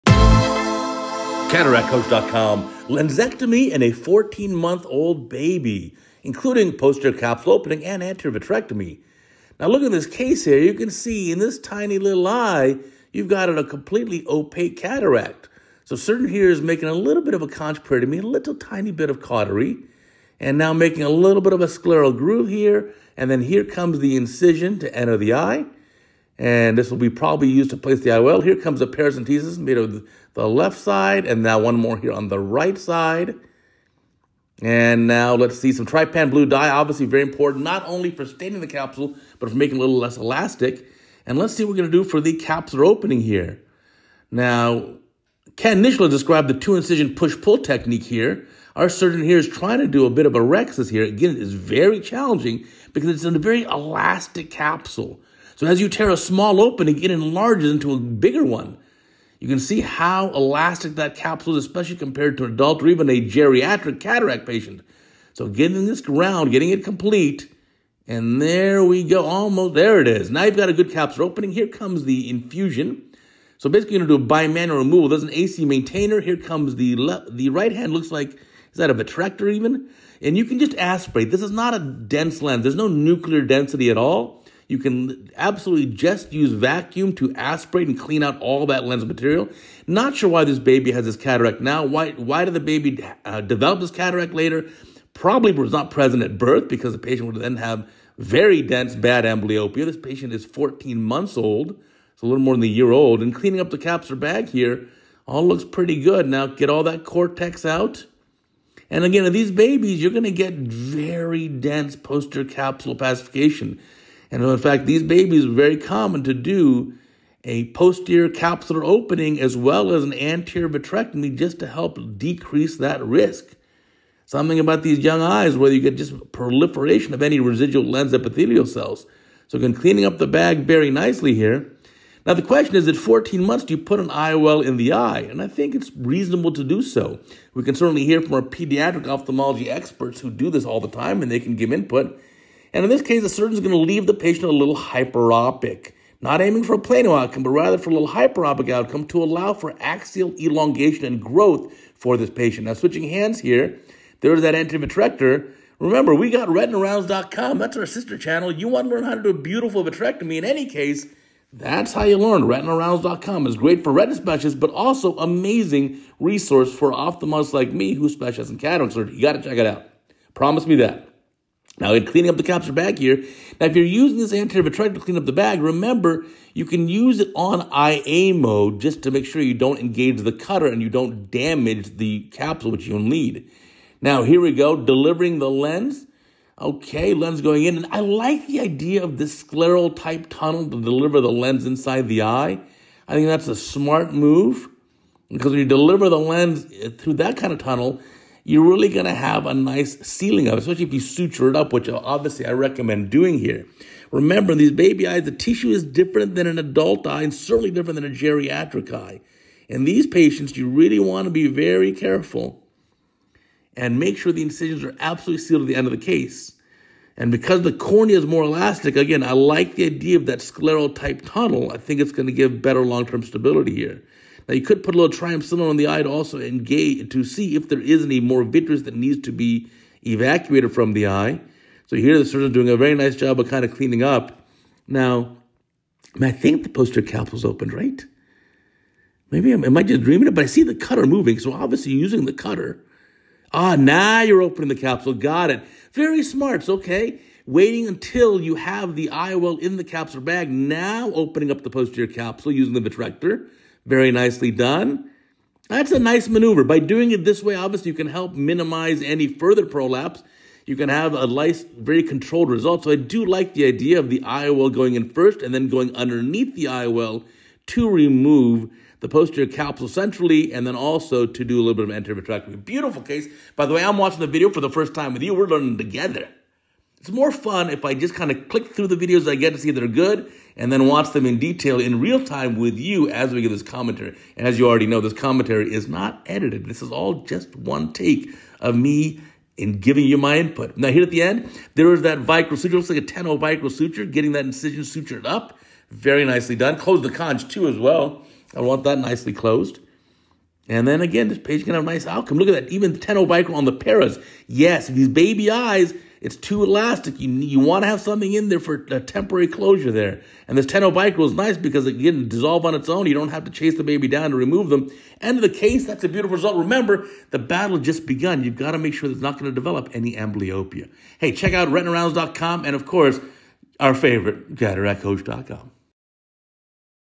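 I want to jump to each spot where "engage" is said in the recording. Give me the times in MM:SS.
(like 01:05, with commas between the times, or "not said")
02:59, 03:46.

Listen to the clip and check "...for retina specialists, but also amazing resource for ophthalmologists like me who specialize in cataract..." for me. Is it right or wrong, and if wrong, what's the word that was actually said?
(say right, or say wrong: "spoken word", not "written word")
right.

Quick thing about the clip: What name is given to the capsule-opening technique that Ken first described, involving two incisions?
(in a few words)
push-pull technique.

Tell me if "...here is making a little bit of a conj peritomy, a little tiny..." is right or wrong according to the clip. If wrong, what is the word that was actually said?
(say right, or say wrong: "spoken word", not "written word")
right.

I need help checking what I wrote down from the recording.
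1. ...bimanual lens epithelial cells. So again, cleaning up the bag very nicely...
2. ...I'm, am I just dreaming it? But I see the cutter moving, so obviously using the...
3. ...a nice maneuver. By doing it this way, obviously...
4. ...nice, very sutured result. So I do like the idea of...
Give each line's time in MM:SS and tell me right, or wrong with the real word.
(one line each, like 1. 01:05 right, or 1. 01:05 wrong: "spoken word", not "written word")
1. 02:07 wrong: "residual", not "bimanual"
2. 03:59 right
3. 04:15 right
4. 04:21 wrong: "controlled", not "sutured".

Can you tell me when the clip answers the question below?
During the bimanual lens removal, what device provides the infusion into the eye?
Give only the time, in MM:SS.
01:15.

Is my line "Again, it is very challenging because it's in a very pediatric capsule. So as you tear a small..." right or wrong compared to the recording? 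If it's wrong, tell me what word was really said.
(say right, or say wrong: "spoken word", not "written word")
wrong: "elastic", not "pediatric".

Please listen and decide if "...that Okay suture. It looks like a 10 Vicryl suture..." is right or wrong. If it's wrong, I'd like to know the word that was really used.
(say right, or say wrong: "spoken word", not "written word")
wrong: "Vicryl", not "Okay".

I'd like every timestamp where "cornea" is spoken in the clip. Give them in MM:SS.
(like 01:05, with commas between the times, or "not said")
03:37.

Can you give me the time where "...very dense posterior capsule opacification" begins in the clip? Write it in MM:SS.
01:50.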